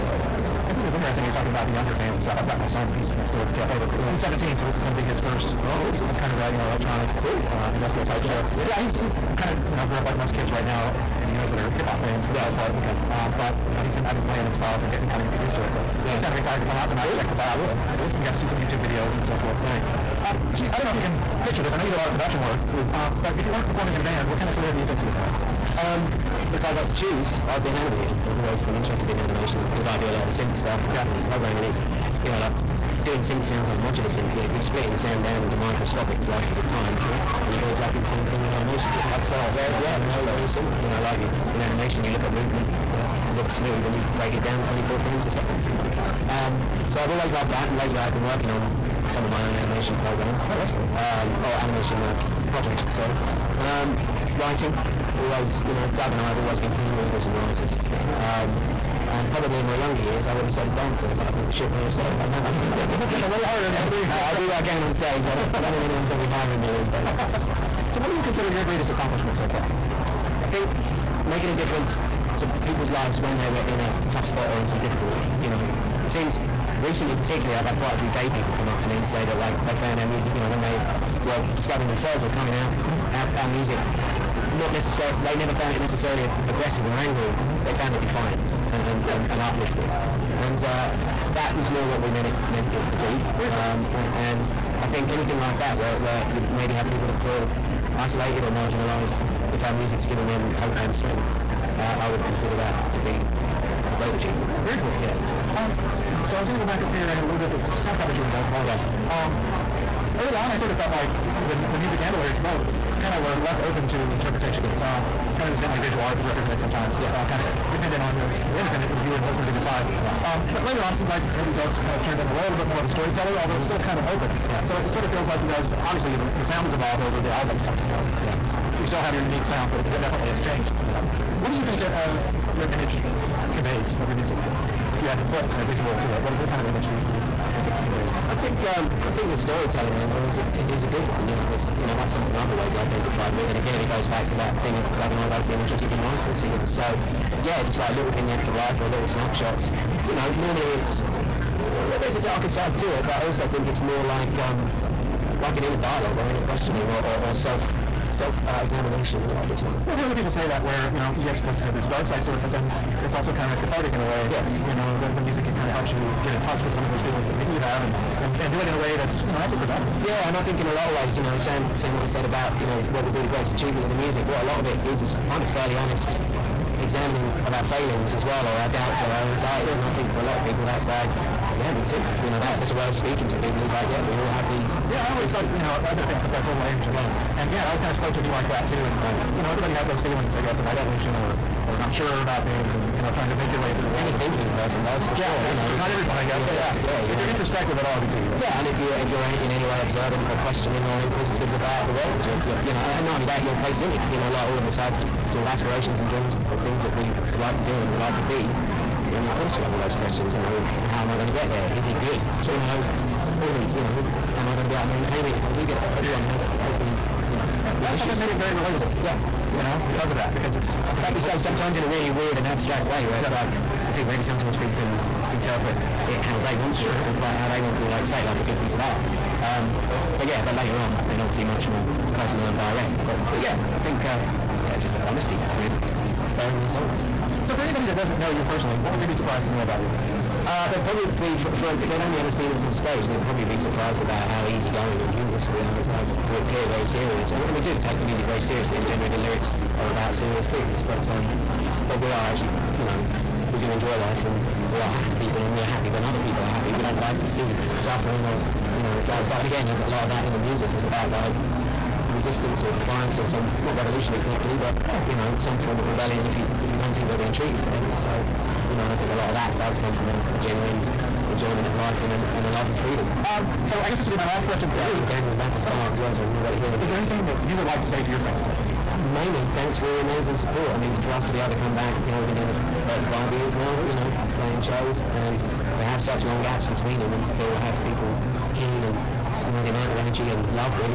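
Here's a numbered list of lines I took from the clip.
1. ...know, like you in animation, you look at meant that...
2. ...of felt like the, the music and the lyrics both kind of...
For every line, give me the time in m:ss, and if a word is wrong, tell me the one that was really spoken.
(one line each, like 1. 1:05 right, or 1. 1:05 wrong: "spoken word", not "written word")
1. 0:40 wrong: "movement", not "meant"
2. 1:50 right.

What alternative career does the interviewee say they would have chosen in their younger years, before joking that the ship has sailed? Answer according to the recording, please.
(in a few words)
a dancer.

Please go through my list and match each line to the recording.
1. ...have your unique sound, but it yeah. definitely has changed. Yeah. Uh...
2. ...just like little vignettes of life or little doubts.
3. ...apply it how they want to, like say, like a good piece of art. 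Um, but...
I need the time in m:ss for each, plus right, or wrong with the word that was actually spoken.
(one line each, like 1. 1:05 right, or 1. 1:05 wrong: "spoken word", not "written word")
1. 2:09 right
2. 2:27 wrong: "snapshots", not "doubts"
3. 3:47 right.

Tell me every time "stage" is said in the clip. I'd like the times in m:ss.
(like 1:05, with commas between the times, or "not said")
1:04, 4:02.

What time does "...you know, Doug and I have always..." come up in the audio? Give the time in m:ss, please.
0:55.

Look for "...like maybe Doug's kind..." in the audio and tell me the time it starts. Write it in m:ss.
2:01.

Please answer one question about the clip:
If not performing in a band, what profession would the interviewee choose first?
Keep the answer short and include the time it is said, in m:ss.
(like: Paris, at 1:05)
animator, at 0:27.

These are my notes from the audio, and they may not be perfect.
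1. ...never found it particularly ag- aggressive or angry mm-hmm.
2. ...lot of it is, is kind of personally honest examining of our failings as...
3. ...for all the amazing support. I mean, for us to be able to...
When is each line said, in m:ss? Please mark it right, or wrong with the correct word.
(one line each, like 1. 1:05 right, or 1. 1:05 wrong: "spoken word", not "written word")
1. 1:25 wrong: "necessarily", not "particularly"
2. 2:54 wrong: "fairly", not "personally"
3. 4:39 right.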